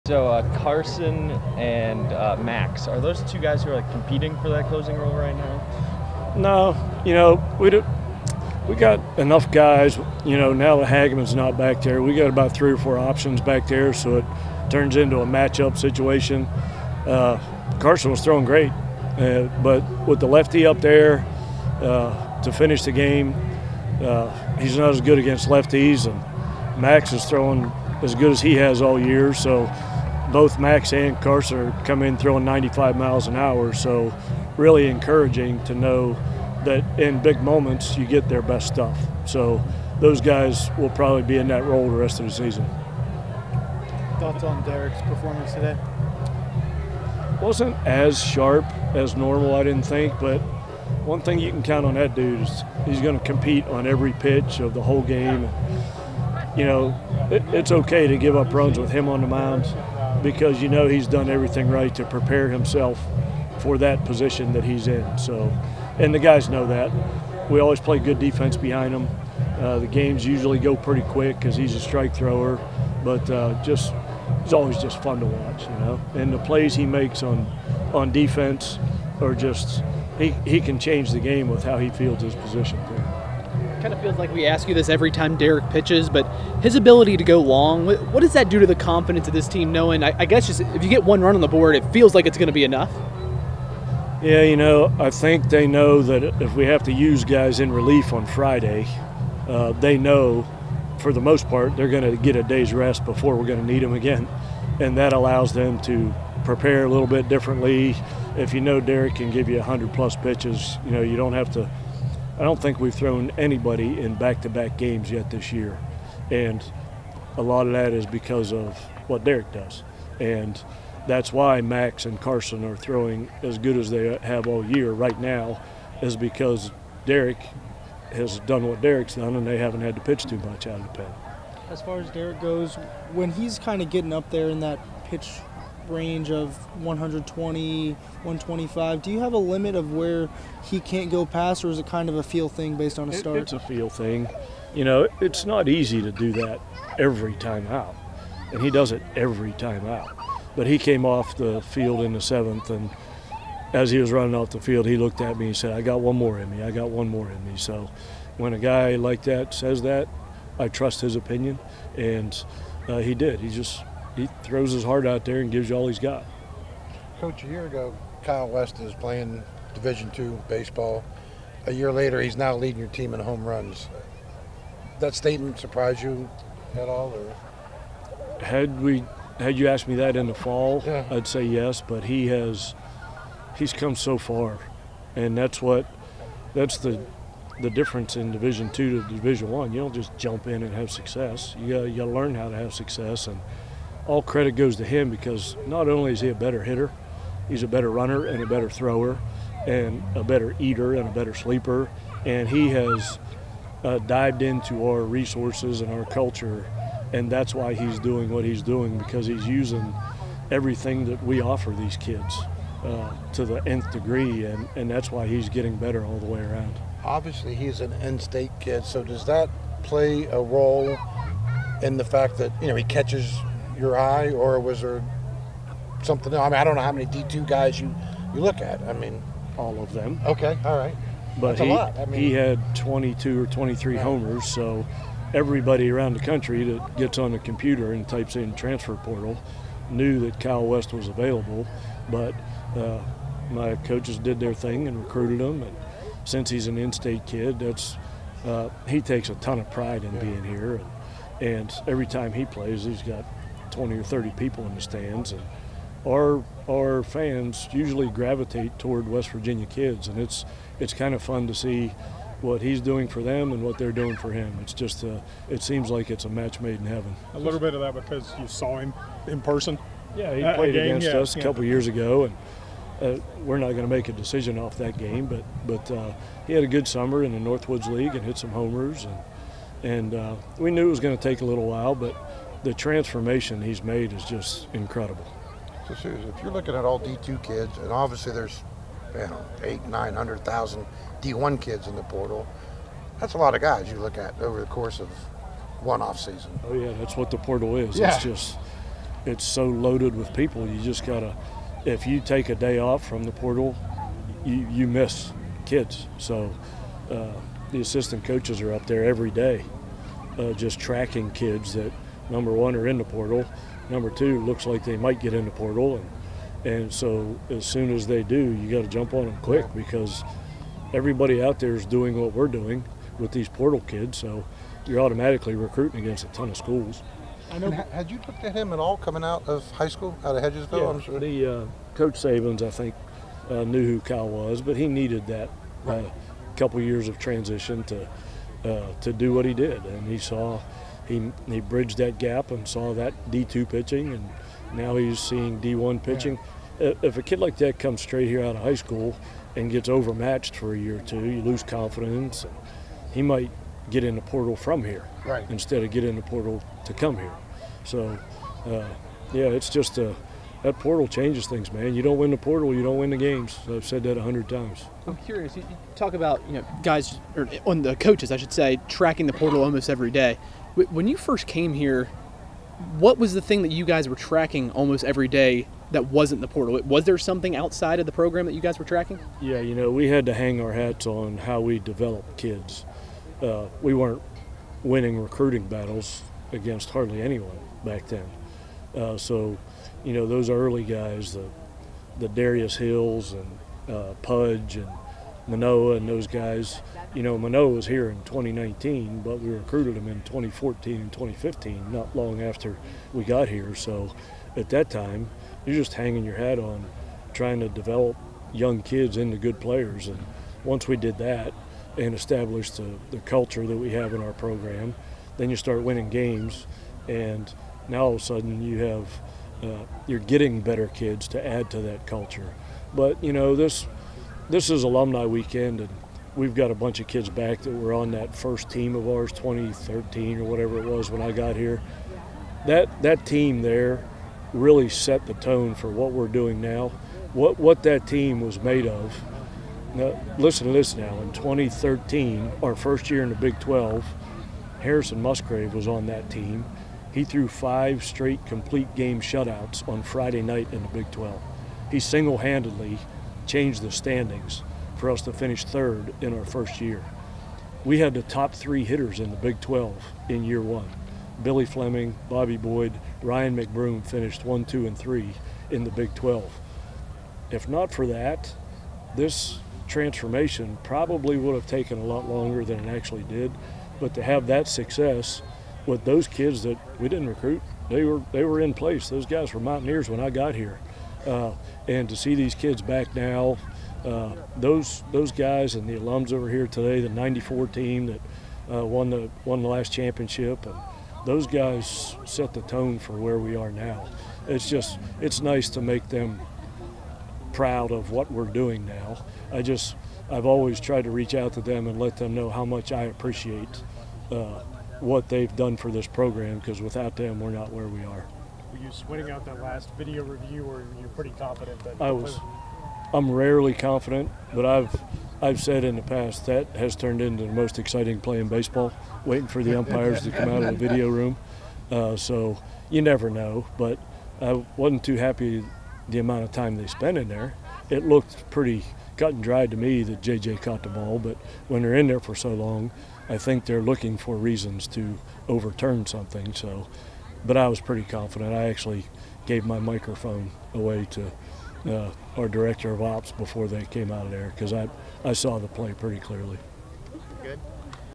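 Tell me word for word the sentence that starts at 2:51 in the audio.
A year later, he's now leading your team in home runs.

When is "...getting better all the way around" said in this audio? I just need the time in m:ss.
3:35.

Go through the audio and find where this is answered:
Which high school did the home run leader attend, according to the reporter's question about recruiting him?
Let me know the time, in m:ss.
5:30.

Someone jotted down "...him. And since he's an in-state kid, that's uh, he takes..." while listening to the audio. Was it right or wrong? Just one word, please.
right.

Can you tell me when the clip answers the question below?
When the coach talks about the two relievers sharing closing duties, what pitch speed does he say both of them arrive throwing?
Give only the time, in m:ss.
0:32.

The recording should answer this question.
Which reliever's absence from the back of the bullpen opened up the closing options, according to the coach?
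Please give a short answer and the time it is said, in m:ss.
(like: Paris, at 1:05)
Hageman, at 0:10.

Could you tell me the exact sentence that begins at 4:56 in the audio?
Oh yeah, that's what the portal is.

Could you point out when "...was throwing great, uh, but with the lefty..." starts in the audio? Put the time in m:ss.
0:18.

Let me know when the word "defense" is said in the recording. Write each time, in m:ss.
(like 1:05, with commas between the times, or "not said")
1:08, 1:18.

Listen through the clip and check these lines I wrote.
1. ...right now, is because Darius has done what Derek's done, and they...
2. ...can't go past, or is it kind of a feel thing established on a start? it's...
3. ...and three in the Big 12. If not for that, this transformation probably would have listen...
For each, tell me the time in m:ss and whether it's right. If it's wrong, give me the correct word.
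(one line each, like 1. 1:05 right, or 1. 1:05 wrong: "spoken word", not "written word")
1. 2:04 wrong: "Derek", not "Darius"
2. 2:20 wrong: "based", not "established"
3. 7:44 wrong: "taken", not "listen".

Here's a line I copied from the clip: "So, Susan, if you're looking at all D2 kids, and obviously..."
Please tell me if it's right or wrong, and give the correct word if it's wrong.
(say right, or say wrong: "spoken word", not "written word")
right.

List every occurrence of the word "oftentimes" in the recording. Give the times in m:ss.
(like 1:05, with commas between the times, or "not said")
not said.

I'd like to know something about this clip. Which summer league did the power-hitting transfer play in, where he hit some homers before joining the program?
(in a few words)
Northwoods League.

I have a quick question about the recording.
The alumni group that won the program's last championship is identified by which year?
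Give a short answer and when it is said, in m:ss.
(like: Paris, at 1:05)
'94, at 8:07.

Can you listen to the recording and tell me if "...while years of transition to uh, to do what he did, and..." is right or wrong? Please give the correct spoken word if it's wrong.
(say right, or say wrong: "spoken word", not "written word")
wrong: "couple", not "while".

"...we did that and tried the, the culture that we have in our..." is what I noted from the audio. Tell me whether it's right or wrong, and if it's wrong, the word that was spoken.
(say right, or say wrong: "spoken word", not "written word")
wrong: "established", not "tried".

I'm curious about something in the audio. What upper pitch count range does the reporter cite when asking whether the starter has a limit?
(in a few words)
120, 125.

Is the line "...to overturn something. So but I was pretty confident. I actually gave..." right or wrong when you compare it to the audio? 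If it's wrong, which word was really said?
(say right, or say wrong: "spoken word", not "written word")
right.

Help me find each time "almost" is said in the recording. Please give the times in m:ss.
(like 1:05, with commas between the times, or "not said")
6:09, 6:14.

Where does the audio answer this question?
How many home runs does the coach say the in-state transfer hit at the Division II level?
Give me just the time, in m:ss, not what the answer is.
3:52.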